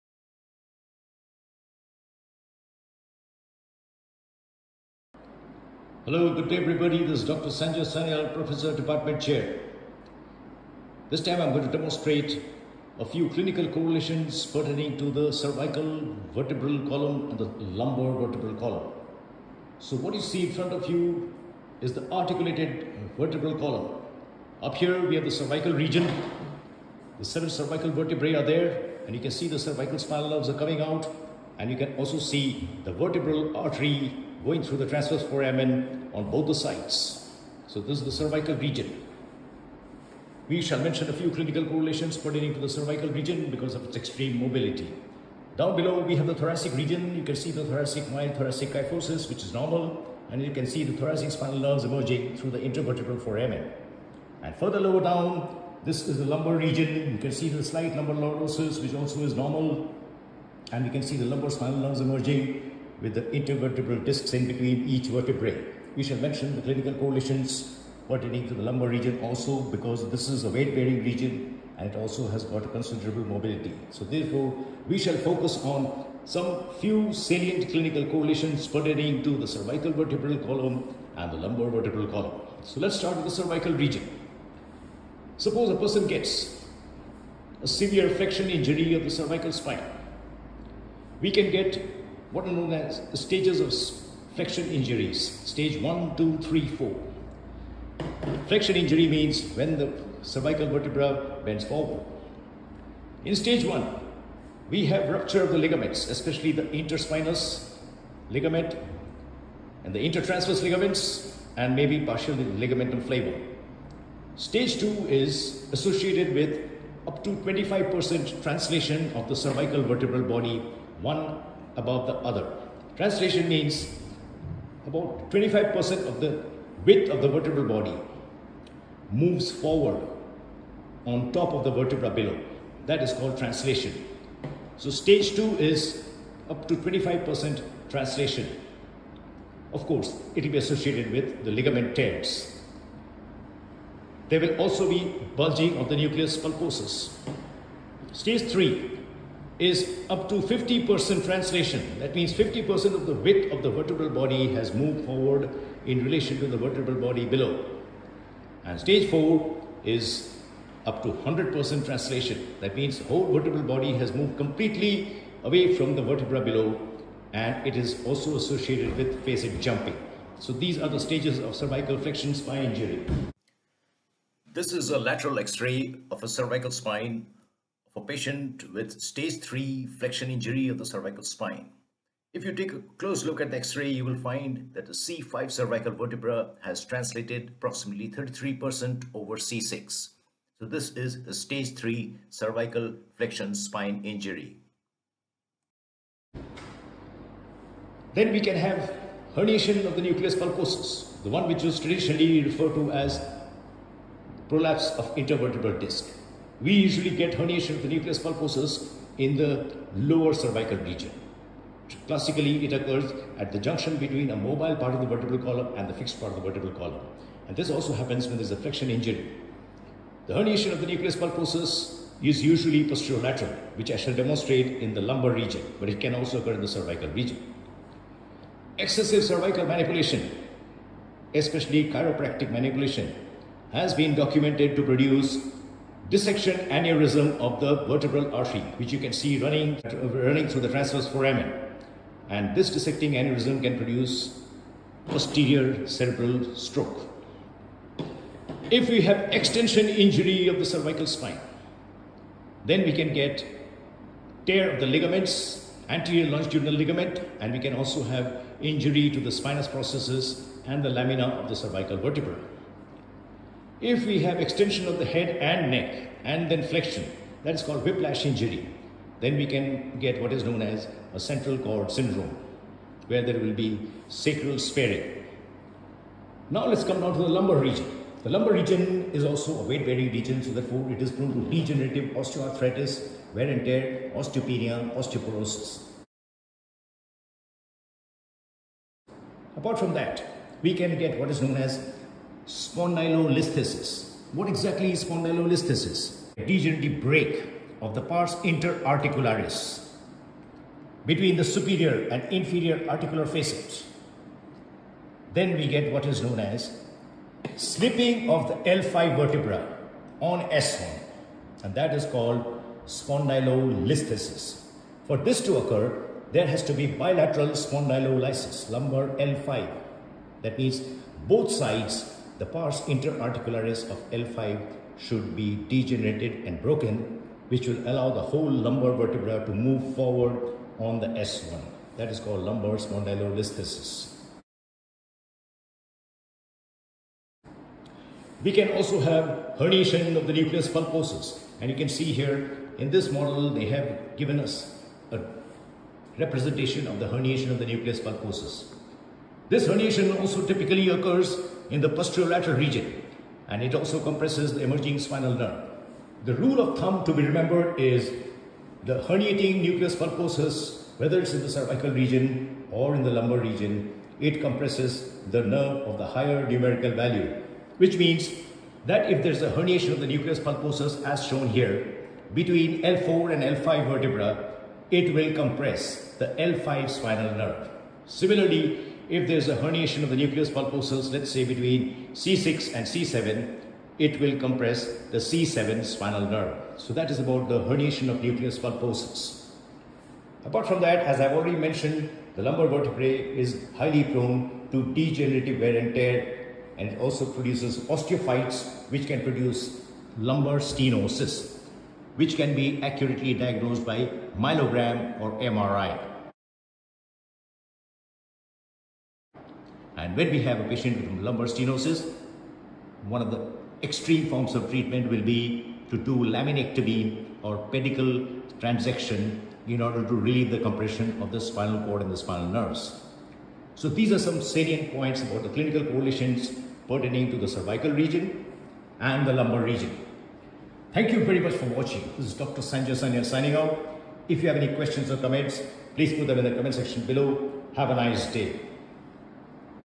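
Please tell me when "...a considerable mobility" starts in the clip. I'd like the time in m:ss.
1:12.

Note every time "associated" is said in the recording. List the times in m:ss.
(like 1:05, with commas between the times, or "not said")
1:55, 2:20, 2:48.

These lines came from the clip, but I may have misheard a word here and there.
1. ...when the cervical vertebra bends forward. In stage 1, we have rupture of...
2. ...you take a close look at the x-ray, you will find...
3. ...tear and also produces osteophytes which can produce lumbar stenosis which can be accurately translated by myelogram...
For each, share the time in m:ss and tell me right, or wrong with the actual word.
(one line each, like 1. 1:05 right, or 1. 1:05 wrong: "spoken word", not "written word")
1. 1:39 right
2. 3:02 right
3. 6:35 wrong: "diagnosed", not "translated".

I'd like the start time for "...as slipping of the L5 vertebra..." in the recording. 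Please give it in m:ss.
5:06.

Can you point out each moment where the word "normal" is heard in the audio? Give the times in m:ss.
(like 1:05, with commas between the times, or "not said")
0:49, 0:59.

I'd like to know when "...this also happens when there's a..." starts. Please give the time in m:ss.
3:37.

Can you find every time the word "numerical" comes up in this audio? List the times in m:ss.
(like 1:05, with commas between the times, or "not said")
6:06.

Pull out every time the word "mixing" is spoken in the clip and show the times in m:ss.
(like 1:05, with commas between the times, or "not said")
not said.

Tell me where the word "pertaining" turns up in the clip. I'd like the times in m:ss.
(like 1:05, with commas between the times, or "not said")
0:14, 0:42, 1:08, 1:18, 7:06.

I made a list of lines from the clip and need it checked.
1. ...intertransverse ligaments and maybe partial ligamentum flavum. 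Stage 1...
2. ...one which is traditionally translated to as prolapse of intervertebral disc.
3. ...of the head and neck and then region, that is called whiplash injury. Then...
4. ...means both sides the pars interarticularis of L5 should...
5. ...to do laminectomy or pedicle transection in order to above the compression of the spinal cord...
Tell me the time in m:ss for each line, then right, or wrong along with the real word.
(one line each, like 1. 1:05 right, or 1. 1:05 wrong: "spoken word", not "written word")
1. 1:49 wrong: "2", not "1"
2. 3:21 wrong: "referred", not "translated"
3. 4:24 wrong: "flexion", not "region"
4. 5:20 right
5. 6:55 wrong: "relieve", not "above".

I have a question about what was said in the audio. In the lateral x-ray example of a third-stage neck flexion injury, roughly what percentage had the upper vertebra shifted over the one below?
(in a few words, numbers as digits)
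33%.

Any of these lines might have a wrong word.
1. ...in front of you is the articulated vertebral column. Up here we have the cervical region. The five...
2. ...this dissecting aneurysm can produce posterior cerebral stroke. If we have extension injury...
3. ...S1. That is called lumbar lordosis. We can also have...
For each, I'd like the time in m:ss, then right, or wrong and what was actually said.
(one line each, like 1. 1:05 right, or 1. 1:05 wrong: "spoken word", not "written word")
1. 0:20 wrong: "seven", not "five"
2. 4:02 right
3. 5:31 wrong: "spondylolisthesis", not "lordosis".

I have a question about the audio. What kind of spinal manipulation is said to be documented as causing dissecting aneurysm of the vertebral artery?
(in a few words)
Chiropractic manipulation.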